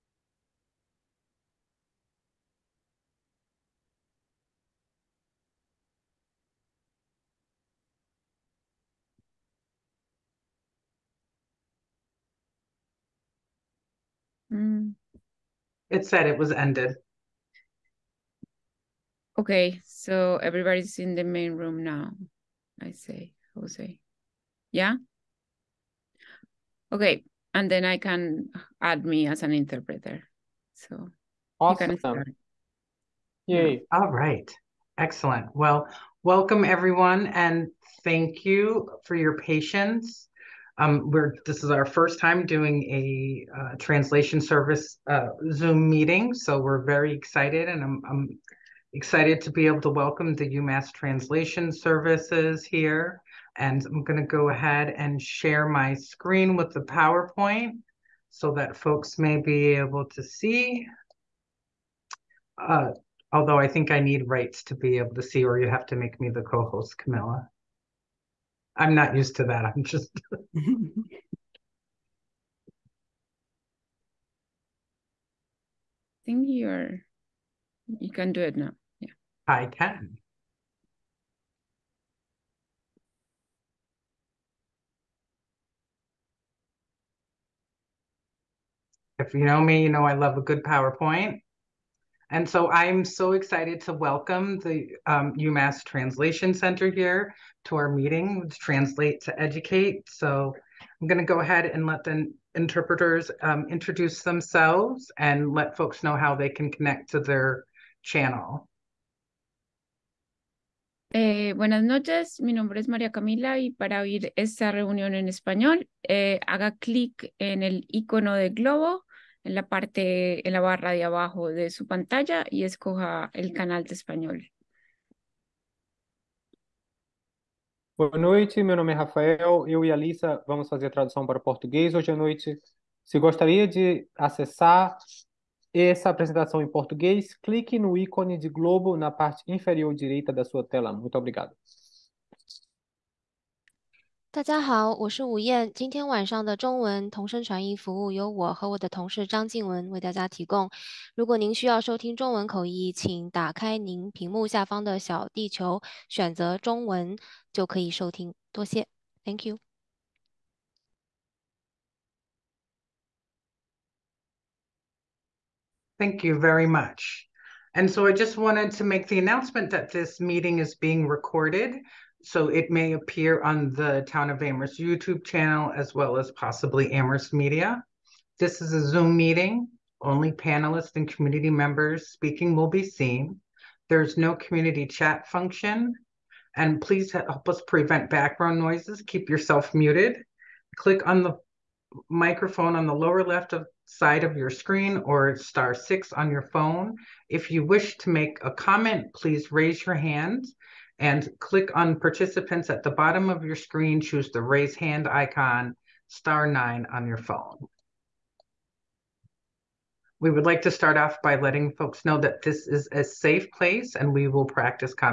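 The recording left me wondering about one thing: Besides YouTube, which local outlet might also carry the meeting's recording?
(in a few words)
Amherst Media.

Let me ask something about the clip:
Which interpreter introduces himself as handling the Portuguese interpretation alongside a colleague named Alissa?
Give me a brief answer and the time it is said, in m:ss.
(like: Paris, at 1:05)
Rafael, at 2:08.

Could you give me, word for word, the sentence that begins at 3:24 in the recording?
Choose the raise hand icon, star nine on your phone.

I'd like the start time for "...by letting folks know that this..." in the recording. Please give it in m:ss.
3:31.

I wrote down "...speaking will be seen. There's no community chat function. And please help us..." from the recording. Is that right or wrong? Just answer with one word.
right.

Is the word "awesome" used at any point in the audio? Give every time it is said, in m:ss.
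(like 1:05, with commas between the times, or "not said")
0:31.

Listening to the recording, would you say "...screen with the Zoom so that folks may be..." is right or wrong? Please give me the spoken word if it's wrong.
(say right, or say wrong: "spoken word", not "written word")
wrong: "PowerPoint", not "Zoom".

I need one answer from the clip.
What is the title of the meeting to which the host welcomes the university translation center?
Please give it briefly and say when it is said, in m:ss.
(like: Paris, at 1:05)
Translate to Educate, at 1:38.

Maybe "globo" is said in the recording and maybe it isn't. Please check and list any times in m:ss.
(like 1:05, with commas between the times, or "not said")
1:58, 2:18.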